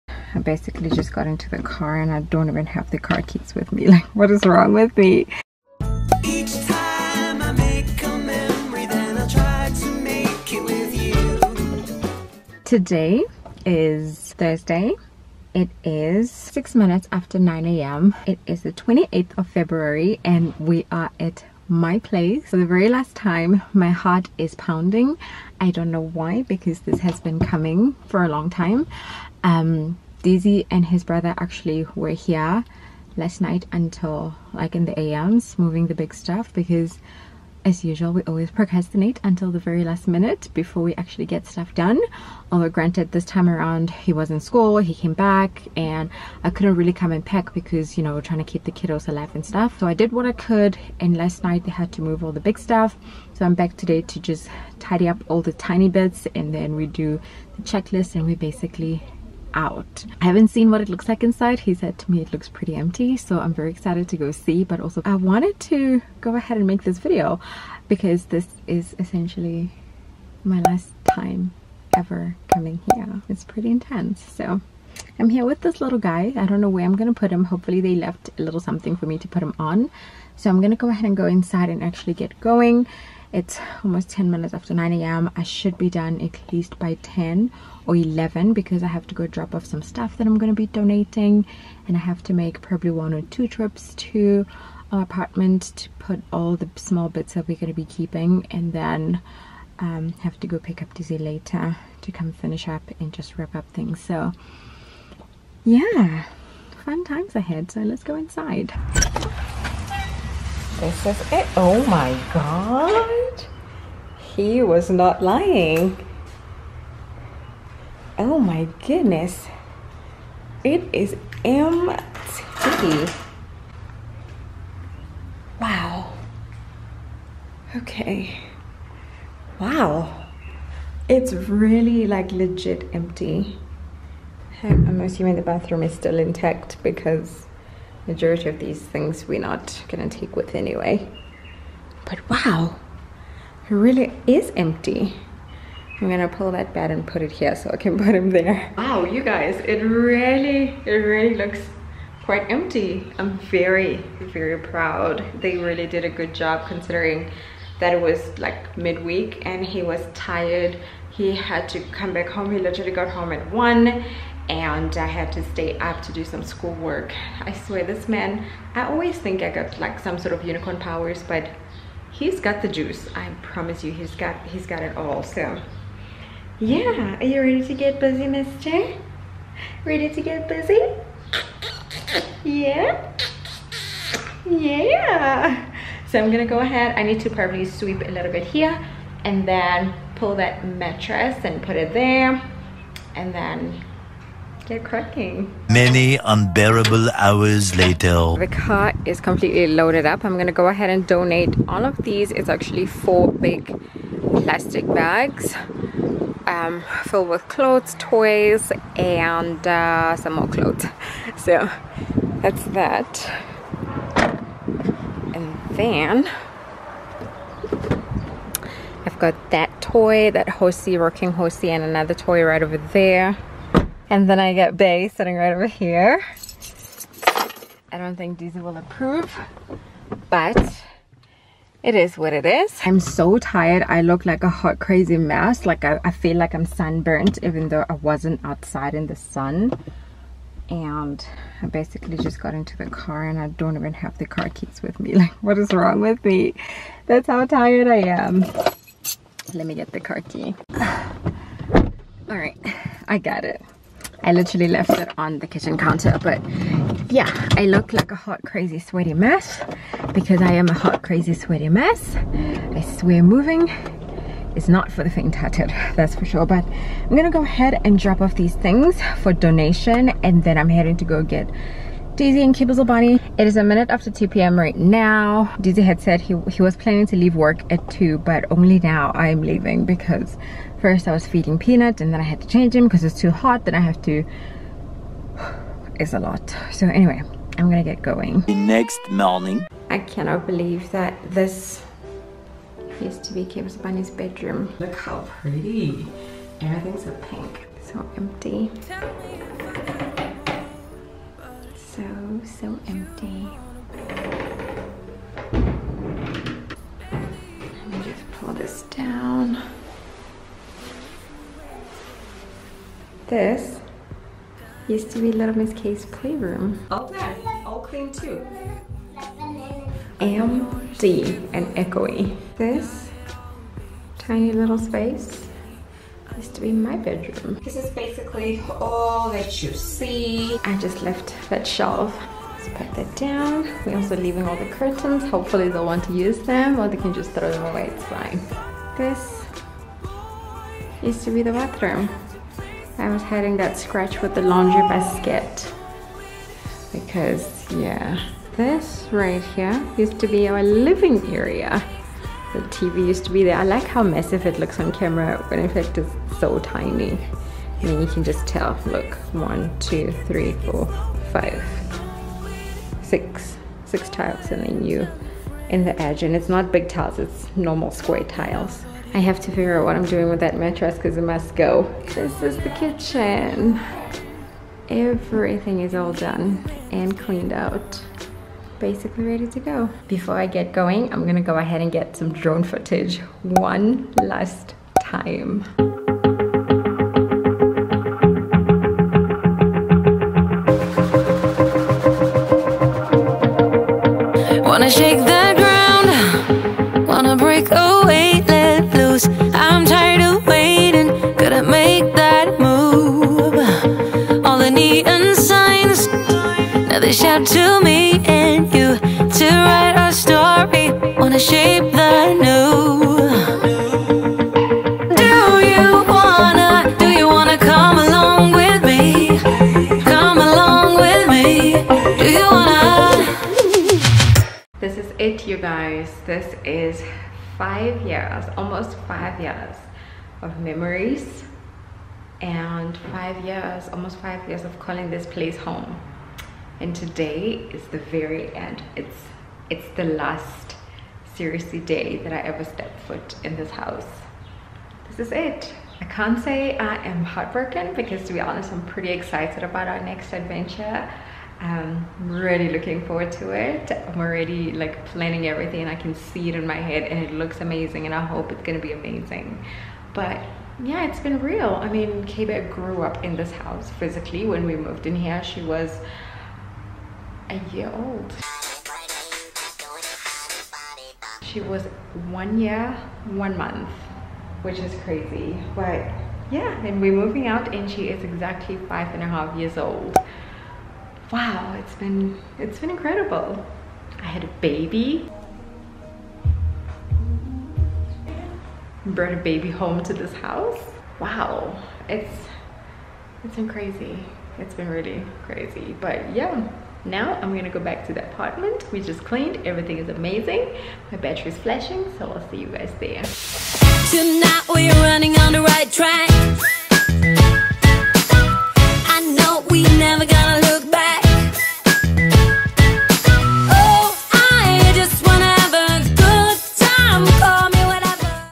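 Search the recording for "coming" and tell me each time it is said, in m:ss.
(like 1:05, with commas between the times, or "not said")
0:27, 1:12.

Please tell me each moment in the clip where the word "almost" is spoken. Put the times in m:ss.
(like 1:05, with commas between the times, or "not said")
1:23, 7:08, 7:13.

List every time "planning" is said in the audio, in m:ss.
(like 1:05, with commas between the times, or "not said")
4:36, 7:35.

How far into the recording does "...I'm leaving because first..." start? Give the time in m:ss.
4:39.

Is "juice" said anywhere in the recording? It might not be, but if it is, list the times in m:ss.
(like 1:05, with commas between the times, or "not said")
2:52.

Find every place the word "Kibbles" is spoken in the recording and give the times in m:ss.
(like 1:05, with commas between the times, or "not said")
4:32, 4:53.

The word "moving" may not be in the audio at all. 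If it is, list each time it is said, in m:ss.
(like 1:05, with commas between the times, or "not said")
0:35, 4:23, 7:57.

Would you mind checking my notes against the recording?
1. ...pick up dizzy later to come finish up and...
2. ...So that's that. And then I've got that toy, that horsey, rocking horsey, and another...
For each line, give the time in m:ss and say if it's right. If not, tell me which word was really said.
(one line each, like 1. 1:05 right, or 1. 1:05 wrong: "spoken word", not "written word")
1. 1:40 right
2. 3:31 right.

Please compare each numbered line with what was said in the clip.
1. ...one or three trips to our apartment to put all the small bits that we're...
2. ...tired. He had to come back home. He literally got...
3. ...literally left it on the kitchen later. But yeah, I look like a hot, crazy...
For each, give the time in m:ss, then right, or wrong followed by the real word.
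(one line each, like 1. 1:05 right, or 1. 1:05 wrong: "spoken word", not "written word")
1. 1:32 wrong: "two", not "three"
2. 2:40 right
3. 4:14 wrong: "counter", not "later".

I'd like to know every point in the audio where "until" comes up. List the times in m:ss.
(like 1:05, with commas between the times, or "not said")
0:33, 0:39.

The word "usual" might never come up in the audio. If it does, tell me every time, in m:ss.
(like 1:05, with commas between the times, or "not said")
0:37.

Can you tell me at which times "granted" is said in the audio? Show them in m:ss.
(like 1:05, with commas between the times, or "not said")
0:42.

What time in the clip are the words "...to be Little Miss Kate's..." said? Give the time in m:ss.
5:15.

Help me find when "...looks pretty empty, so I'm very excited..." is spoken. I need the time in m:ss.
1:02.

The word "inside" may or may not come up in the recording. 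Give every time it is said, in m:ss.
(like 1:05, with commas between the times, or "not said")
1:01, 1:21, 1:48.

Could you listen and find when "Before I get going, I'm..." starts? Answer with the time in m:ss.
6:20.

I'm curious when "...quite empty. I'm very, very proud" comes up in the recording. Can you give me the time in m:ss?
2:32.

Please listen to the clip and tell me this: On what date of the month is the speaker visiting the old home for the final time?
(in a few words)
28th of February.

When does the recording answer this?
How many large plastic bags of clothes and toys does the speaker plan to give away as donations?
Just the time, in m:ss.
3:22.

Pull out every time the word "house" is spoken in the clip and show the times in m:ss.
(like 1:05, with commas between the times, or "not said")
7:23, 7:43, 8:10.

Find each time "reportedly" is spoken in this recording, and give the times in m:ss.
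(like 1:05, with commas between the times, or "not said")
not said.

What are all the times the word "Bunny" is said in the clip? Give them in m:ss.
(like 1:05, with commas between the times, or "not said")
4:32, 4:53.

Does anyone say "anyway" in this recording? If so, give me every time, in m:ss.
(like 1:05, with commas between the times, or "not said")
2:20, 4:46.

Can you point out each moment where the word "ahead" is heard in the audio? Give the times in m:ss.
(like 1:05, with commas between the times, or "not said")
1:06, 1:20, 1:47, 3:06, 3:20, 4:27, 6:21.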